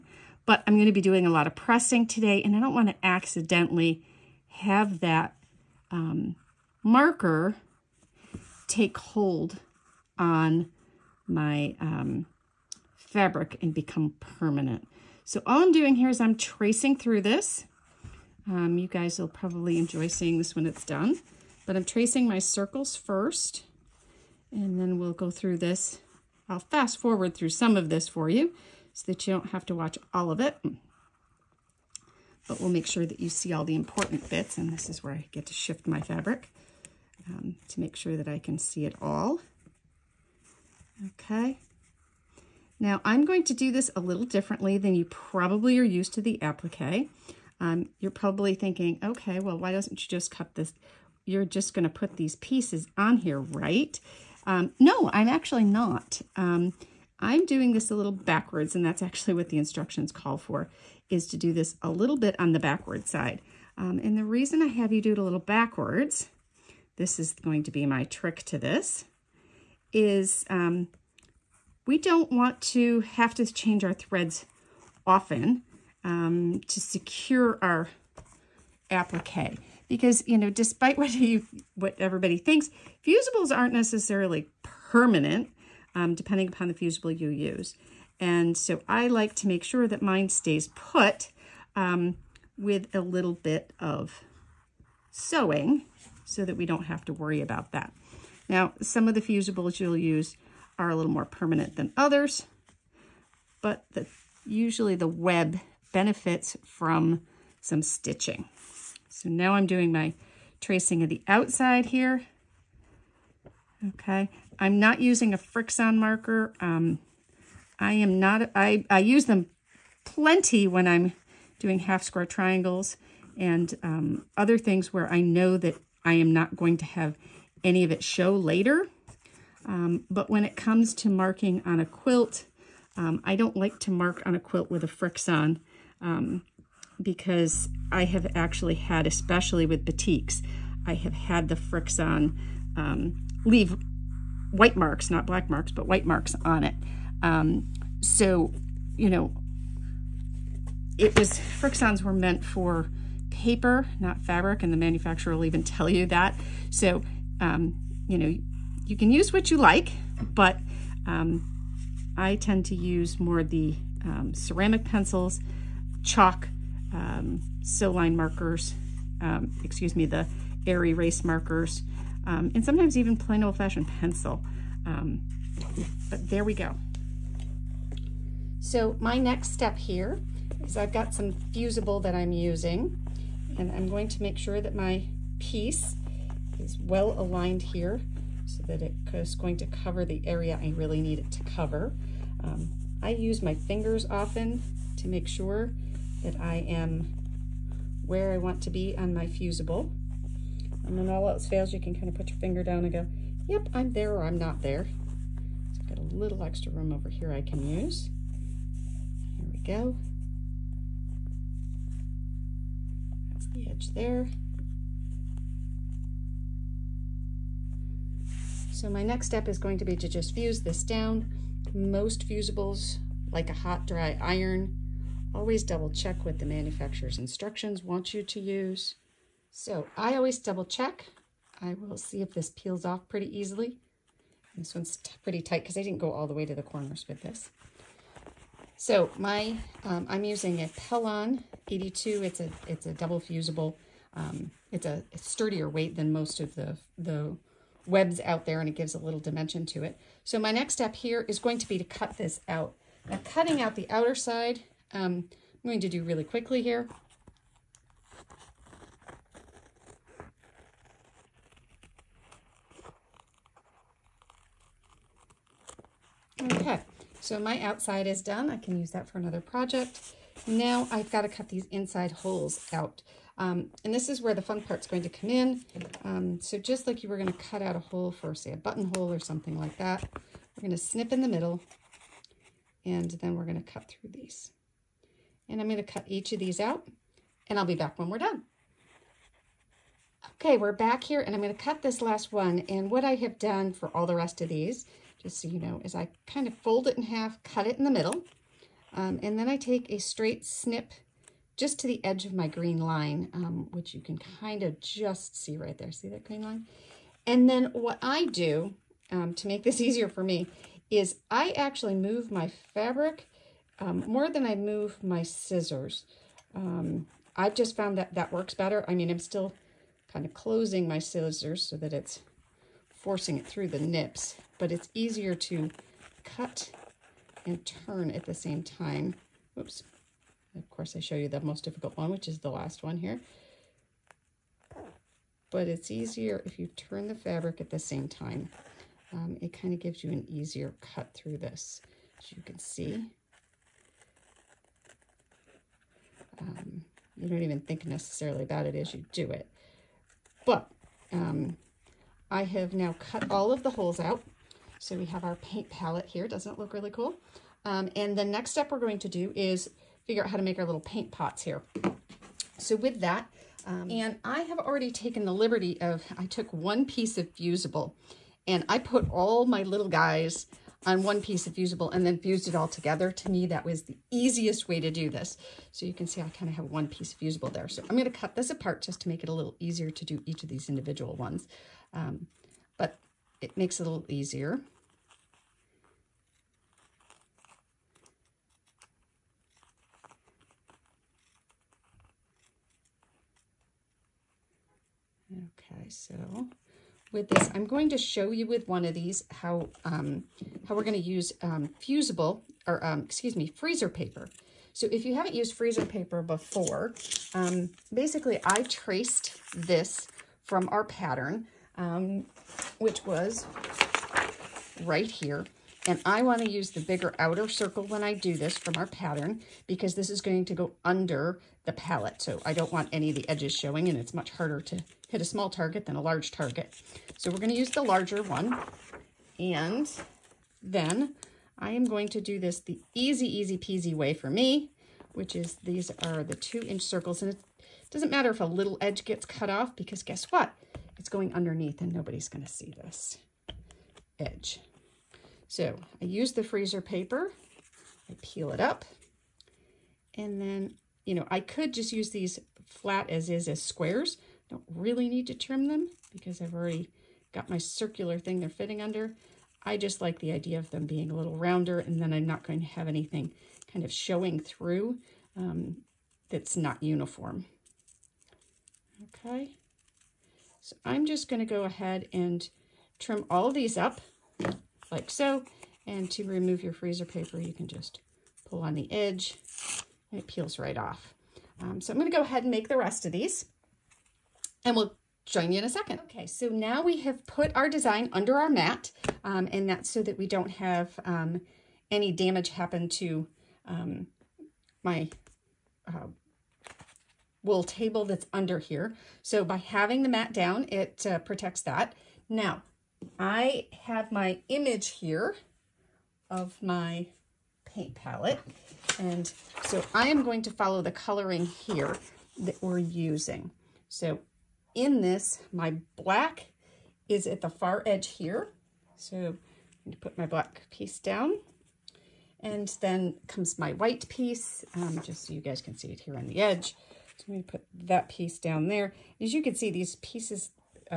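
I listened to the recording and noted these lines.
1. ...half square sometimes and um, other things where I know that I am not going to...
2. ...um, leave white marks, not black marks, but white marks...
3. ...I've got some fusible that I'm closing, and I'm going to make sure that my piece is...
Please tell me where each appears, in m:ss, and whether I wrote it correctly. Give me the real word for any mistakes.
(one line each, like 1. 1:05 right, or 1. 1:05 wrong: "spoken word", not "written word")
1. 2:01 wrong: "triangles", not "sometimes"
2. 2:22 right
3. 3:00 wrong: "using", not "closing".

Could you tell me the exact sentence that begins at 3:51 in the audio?
I will see if this peels off pretty easily.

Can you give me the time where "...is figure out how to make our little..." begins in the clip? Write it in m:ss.
5:59.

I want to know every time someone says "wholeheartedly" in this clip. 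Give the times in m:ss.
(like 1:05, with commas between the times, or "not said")
not said.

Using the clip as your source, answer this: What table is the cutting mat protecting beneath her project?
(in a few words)
wool table.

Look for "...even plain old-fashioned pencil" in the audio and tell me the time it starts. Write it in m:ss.
2:52.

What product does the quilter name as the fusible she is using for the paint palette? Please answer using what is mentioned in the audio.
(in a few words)
Pellon 82.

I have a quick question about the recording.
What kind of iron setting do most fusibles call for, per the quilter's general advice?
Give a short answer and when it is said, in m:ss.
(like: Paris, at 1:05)
hot dry iron, at 3:43.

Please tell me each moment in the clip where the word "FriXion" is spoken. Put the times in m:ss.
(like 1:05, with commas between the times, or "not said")
1:55, 2:14, 2:21, 2:31.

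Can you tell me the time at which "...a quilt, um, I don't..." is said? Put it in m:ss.
2:11.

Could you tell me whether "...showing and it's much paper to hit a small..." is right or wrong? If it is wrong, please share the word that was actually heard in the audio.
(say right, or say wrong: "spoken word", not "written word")
wrong: "harder", not "paper".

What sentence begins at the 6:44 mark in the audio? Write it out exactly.
So if you haven't used freezer paper before, um, basically I traced this from our pattern, um, which was right here.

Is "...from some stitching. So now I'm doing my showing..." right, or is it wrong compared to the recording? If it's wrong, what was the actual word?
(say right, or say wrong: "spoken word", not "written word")
wrong: "tracing", not "showing".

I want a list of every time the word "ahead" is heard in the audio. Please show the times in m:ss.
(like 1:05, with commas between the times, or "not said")
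7:51, 8:02.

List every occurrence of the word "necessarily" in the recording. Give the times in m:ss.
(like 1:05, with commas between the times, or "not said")
1:23, 5:47.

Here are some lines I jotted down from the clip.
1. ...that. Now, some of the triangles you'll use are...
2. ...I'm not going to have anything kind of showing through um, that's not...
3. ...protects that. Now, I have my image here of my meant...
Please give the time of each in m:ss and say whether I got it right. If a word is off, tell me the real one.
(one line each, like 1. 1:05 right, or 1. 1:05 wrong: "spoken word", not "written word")
1. 1:37 wrong: "fusibles", not "triangles"
2. 7:42 right
3. 8:21 wrong: "paint", not "meant".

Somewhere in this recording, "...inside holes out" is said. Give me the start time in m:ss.
4:31.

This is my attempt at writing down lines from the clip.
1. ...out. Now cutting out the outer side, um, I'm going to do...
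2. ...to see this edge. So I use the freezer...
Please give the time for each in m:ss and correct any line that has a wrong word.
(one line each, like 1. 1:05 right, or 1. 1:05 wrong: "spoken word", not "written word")
1. 4:12 right
2. 7:22 right.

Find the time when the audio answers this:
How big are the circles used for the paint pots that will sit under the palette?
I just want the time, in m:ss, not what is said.
7:16.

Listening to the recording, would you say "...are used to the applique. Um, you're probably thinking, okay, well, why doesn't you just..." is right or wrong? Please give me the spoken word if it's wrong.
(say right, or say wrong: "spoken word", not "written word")
right.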